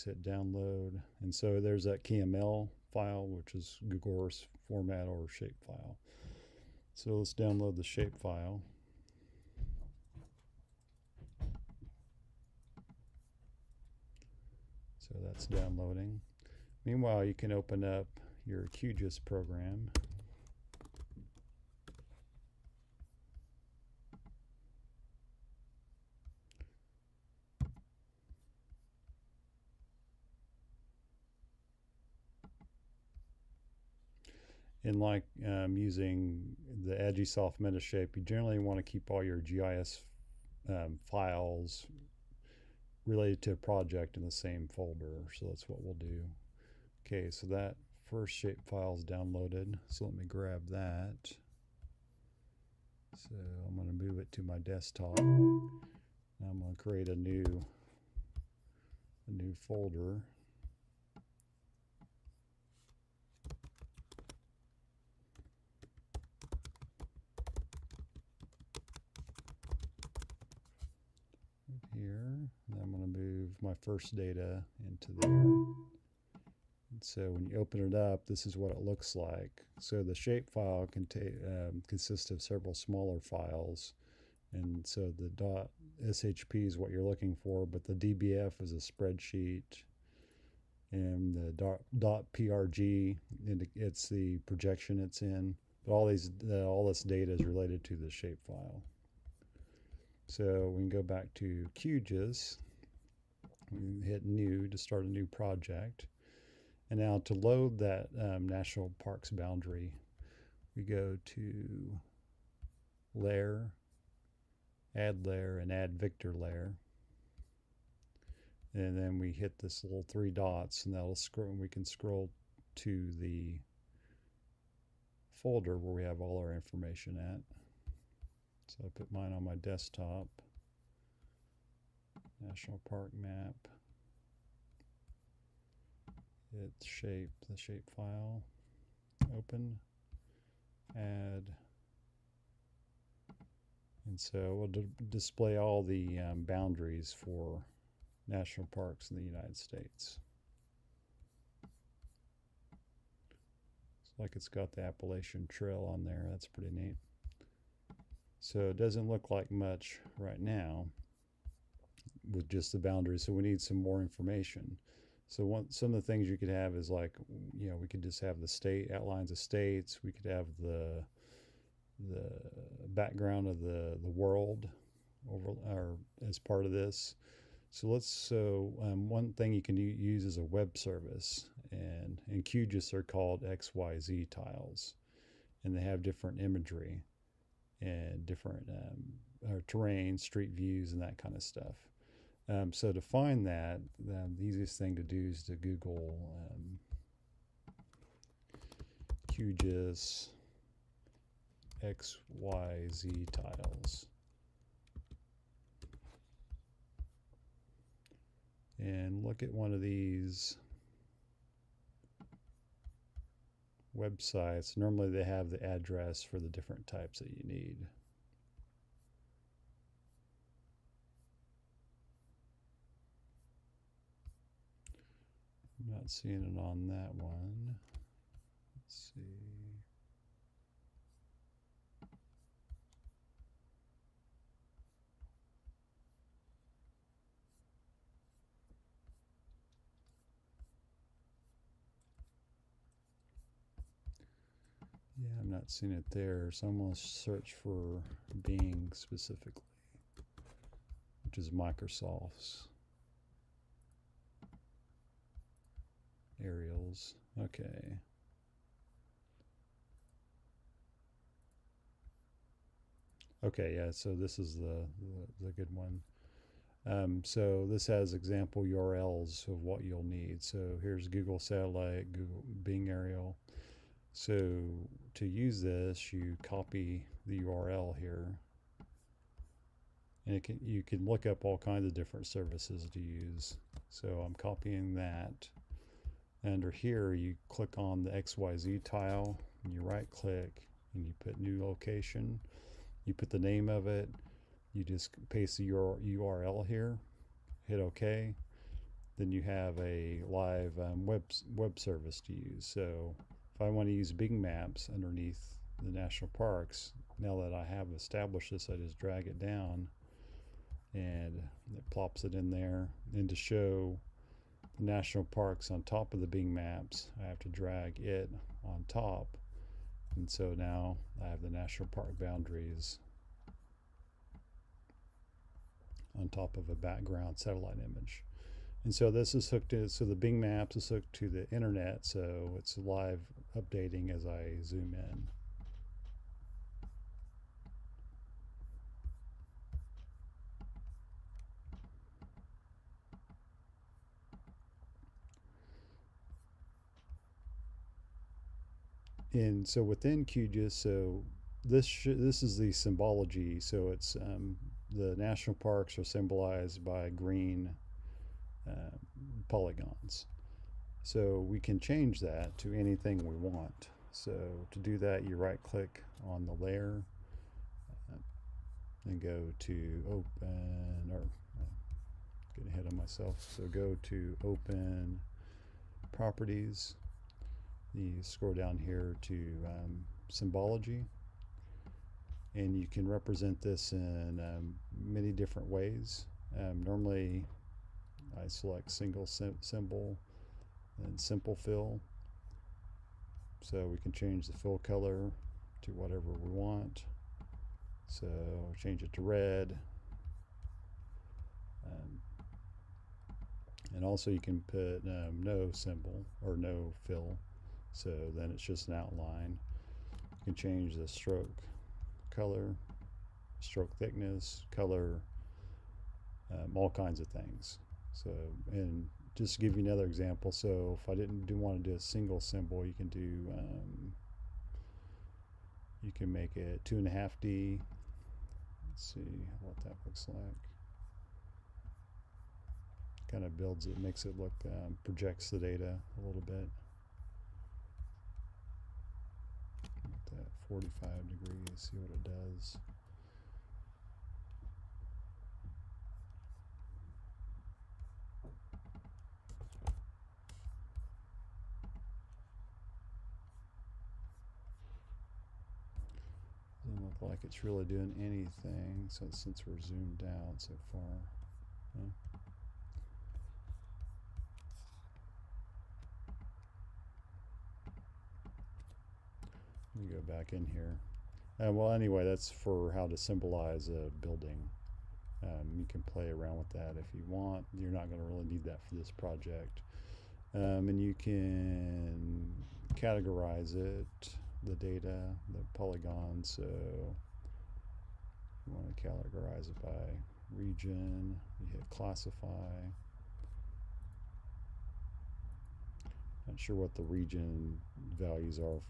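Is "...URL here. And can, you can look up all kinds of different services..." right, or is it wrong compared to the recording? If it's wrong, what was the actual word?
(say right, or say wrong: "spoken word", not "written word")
right.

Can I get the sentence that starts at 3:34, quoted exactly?
Normally they have the address for the different types that you need.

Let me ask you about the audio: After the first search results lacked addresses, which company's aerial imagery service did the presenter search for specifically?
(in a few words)
Microsoft.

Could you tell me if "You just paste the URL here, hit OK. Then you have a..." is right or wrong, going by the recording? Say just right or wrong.
right.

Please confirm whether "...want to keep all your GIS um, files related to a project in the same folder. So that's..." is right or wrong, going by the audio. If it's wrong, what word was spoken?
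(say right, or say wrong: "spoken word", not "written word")
right.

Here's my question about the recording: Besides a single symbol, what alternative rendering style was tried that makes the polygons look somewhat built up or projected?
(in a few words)
Two and a half D.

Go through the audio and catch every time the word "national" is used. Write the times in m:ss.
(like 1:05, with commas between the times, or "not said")
1:48, 2:12, 2:28, 5:05, 5:14, 5:21, 5:55.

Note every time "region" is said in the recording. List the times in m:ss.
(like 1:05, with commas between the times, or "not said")
8:10, 8:17.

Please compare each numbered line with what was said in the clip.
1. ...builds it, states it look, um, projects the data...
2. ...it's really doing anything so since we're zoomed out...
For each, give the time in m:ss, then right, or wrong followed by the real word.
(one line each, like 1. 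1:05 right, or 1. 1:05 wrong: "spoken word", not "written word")
1. 7:13 wrong: "makes", not "states"
2. 7:37 right.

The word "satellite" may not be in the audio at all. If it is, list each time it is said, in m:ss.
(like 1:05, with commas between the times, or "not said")
4:31, 5:27.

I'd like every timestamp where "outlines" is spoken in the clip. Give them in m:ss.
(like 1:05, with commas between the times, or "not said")
2:48, 6:48.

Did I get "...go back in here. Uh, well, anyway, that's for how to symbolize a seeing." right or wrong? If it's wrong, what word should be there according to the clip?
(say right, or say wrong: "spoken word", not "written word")
wrong: "building", not "seeing".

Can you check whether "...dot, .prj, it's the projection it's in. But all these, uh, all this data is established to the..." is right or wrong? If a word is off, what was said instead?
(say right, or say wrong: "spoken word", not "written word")
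wrong: "related", not "established".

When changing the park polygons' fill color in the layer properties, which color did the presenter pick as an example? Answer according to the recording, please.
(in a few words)
Red.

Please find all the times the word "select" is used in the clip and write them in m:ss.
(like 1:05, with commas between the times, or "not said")
6:28.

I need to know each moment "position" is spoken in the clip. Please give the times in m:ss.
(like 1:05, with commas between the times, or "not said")
not said.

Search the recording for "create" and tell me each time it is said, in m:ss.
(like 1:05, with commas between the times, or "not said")
0:56.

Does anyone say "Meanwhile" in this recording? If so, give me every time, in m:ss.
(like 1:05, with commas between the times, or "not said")
0:16.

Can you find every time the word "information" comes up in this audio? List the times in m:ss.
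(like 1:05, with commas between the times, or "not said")
2:06, 2:44.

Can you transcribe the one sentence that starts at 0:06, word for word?
So let's download the shape file.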